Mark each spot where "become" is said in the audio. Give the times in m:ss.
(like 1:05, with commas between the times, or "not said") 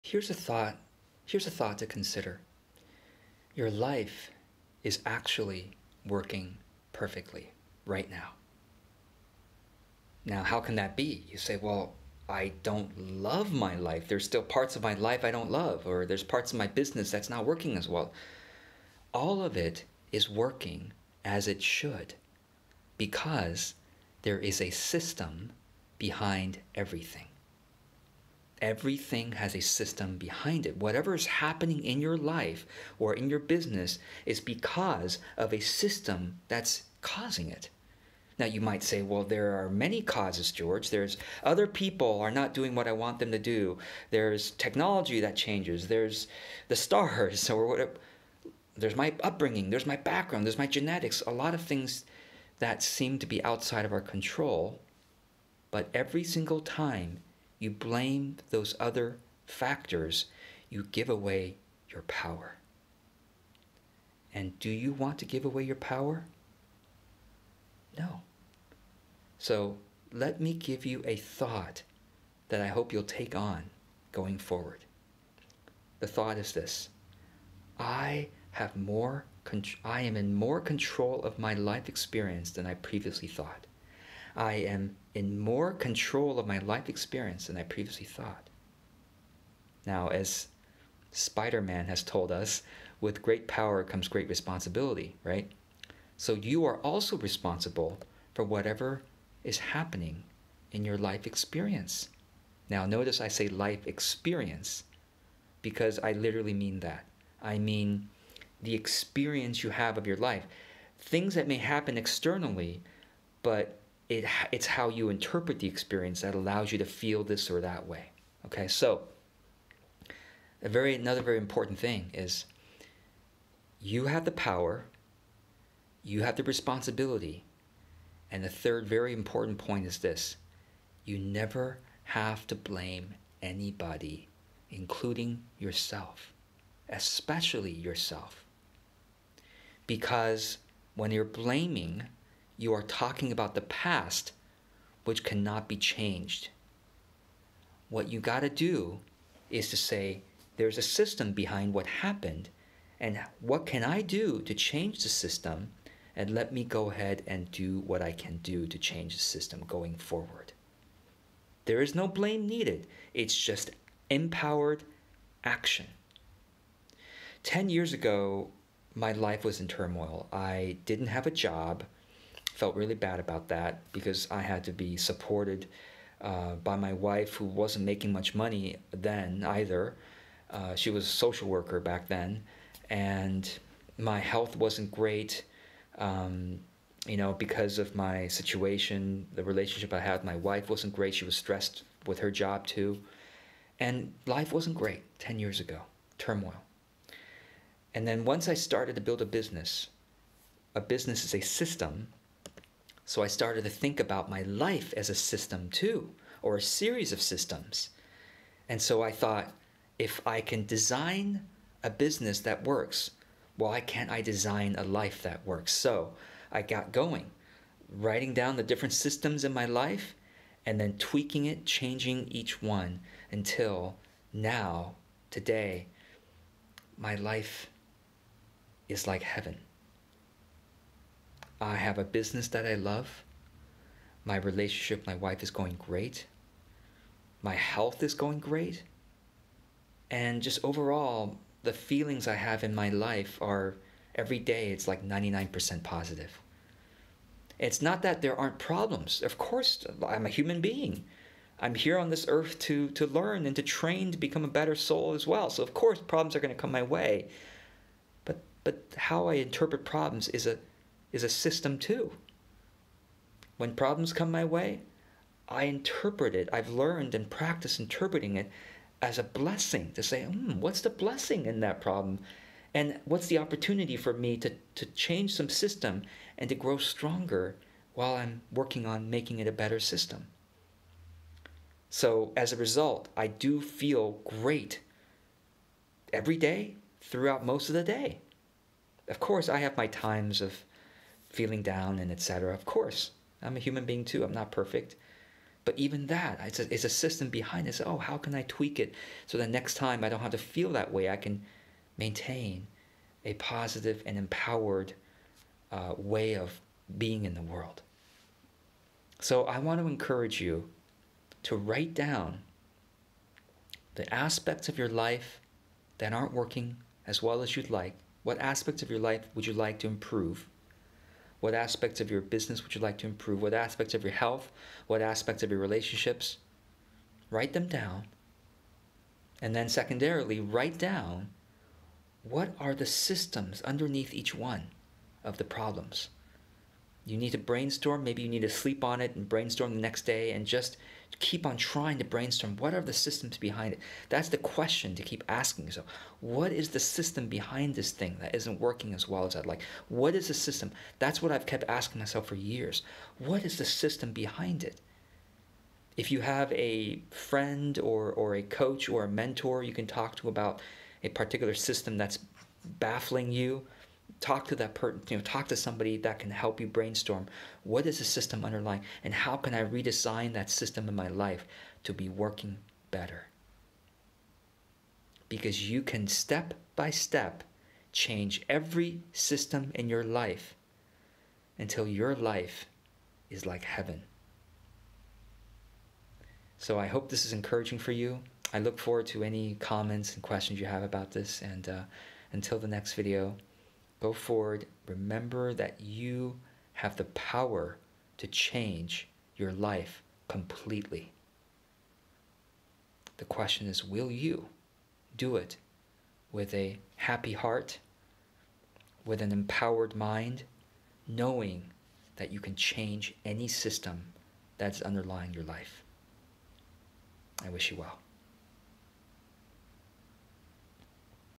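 4:14.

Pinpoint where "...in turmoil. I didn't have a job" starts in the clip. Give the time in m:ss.
2:49.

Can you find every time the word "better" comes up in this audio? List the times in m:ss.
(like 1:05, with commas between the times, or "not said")
4:14, 4:39, 6:12.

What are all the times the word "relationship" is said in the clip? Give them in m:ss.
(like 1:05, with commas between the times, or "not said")
3:09, 3:54, 5:25.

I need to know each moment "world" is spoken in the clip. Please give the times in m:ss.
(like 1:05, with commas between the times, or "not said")
5:07.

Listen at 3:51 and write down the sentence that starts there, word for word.
I have a business that I love.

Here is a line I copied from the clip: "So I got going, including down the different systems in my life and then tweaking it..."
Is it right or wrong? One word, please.
wrong.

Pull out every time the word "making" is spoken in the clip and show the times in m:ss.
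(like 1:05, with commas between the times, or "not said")
2:57, 4:39.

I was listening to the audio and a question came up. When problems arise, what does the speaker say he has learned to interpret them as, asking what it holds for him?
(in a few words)
A blessing.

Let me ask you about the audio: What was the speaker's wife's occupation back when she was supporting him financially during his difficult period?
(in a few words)
Social worker.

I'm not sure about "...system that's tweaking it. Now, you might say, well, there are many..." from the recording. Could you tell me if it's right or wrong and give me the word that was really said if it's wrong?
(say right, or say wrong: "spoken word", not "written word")
wrong: "causing", not "tweaking".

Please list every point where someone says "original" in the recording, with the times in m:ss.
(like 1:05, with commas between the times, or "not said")
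not said.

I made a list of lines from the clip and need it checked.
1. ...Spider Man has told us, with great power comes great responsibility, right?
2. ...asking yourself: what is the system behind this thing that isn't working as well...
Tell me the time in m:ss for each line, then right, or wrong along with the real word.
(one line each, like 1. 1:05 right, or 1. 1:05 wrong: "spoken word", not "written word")
1. 1:31 right
2. 5:45 right.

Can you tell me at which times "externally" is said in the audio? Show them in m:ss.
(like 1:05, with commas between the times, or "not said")
1:51.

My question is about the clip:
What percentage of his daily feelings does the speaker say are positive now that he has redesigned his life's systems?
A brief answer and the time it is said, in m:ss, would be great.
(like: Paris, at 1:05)
99%, at 4:05.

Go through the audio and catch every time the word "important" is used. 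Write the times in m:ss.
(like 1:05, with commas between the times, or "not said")
2:01, 2:09.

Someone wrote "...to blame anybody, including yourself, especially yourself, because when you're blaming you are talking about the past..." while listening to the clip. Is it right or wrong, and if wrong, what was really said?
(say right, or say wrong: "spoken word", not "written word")
right.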